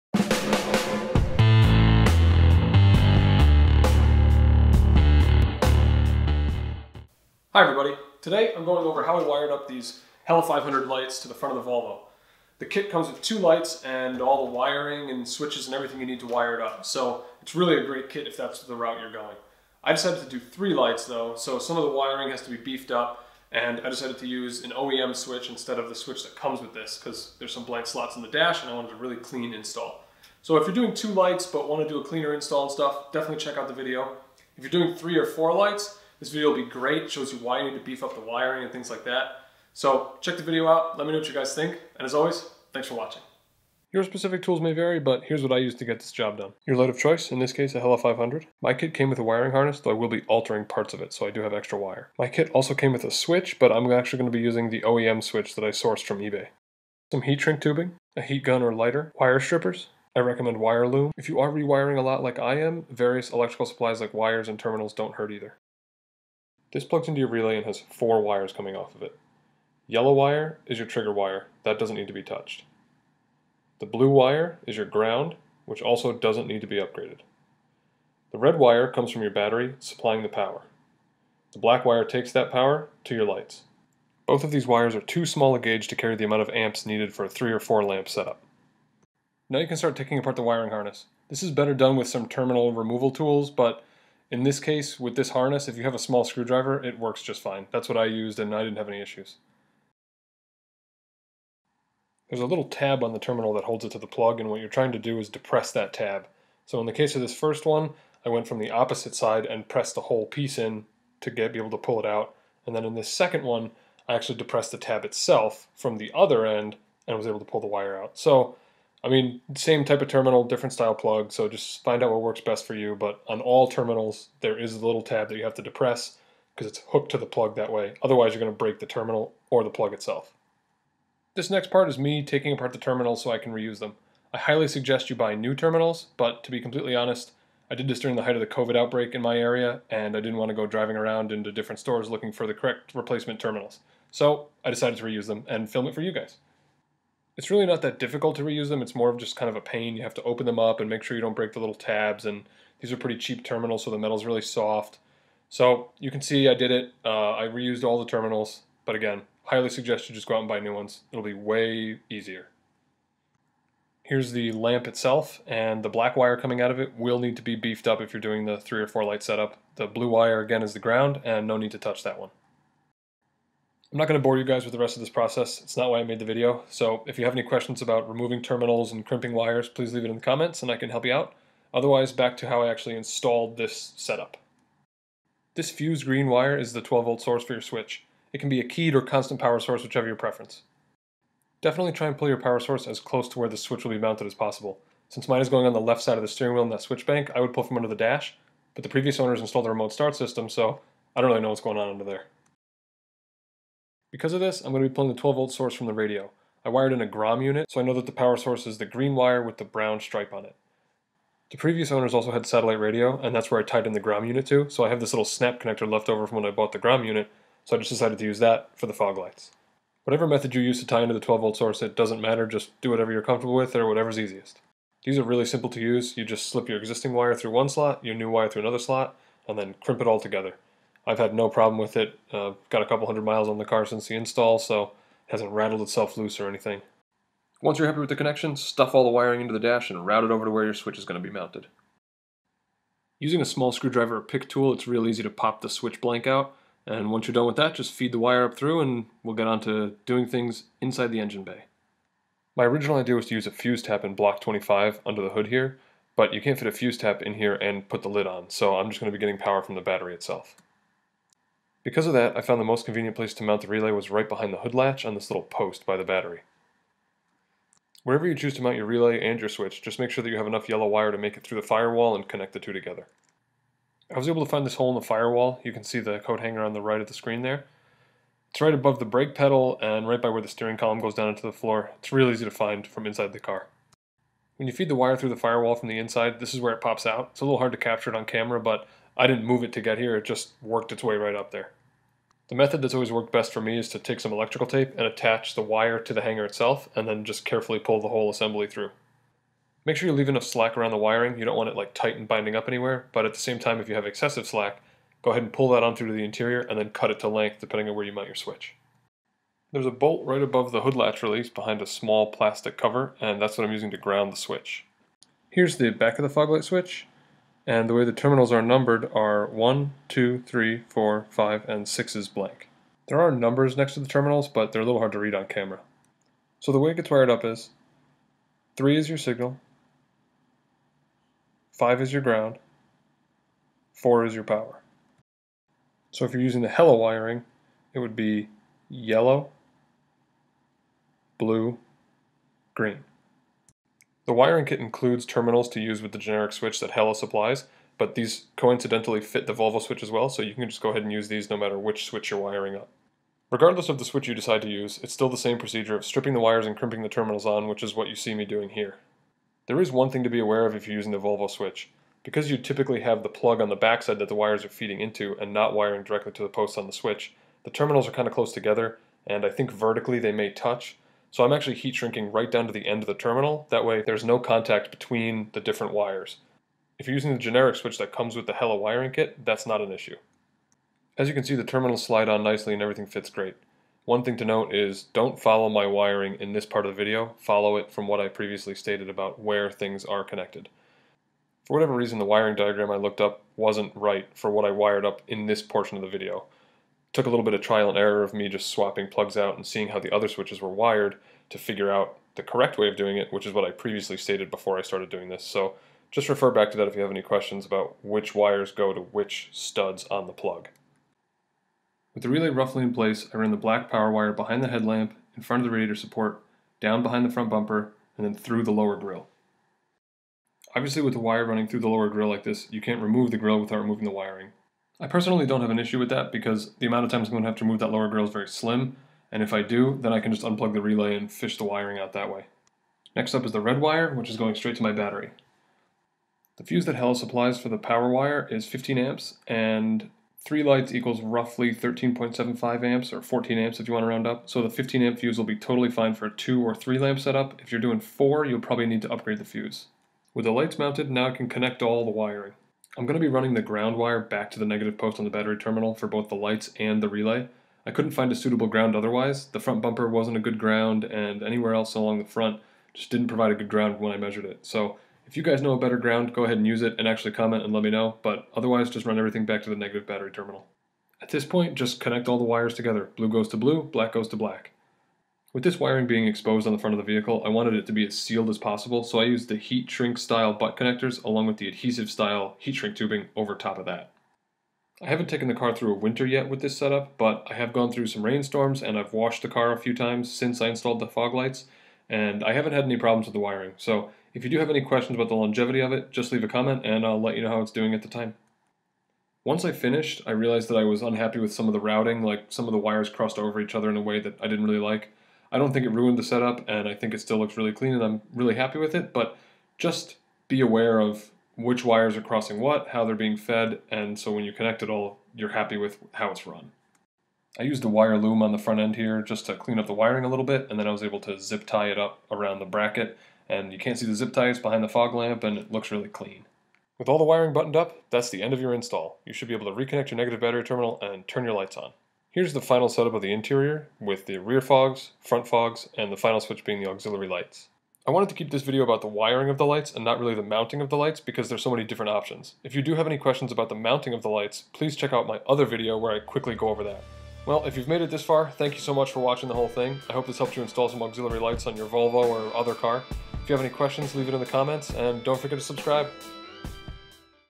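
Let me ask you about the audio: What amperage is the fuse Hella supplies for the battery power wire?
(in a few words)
15 amps.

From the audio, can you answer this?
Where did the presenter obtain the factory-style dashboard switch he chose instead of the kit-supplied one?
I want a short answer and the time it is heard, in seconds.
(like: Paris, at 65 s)
eBay, at 56 s.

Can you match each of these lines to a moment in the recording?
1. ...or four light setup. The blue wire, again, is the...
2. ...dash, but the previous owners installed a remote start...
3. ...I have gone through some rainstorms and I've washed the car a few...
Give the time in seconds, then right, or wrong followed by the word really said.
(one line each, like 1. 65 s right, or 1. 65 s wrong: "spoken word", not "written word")
1. 168 s right
2. 197 s right
3. 487 s right.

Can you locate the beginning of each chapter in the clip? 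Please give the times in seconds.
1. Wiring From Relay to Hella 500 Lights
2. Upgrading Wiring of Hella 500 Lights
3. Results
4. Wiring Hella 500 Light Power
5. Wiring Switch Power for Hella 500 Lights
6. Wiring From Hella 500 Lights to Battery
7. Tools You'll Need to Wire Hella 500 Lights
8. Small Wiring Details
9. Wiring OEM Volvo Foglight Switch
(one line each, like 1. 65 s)
1. 410 s
2. 66 s
3. 526 s
4. 252 s
5. 185 s
6. 450 s
7. 44 s
8. 499 s
9. 315 s.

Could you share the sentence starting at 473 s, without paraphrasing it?
Blue goes to blue, black goes to black.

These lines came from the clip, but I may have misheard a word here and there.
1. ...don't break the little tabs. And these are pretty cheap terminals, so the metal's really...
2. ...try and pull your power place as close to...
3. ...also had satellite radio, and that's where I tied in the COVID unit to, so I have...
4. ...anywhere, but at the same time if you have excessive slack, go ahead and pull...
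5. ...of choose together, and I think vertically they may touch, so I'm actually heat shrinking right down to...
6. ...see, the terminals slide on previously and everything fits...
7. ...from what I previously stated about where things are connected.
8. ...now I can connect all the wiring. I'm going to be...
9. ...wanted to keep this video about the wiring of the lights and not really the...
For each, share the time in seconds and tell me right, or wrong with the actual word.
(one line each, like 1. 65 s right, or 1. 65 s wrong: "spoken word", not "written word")
1. 151 s right
2. 191 s wrong: "source", not "place"
3. 212 s wrong: "Grom", not "COVID"
4. 302 s right
5. 368 s wrong: "close", not "choose"
6. 381 s wrong: "nicely", not "previously"
7. 387 s right
8. 451 s right
9. 538 s right.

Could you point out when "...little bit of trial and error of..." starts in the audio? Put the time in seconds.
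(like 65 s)
397 s.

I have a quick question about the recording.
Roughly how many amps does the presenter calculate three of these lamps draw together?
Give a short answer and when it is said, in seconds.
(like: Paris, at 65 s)
13.75 amps, at 441 s.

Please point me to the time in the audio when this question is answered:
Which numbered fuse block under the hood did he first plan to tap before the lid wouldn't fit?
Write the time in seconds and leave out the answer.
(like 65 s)
254 s.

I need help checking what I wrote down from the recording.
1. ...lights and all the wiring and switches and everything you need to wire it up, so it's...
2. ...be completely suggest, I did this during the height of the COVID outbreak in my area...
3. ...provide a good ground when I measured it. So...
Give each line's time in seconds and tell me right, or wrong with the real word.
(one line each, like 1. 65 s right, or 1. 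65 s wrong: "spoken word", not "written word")
1. 13 s right
2. 136 s wrong: "honest", not "suggest"
3. 463 s right.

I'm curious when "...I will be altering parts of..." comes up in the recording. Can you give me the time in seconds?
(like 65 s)
49 s.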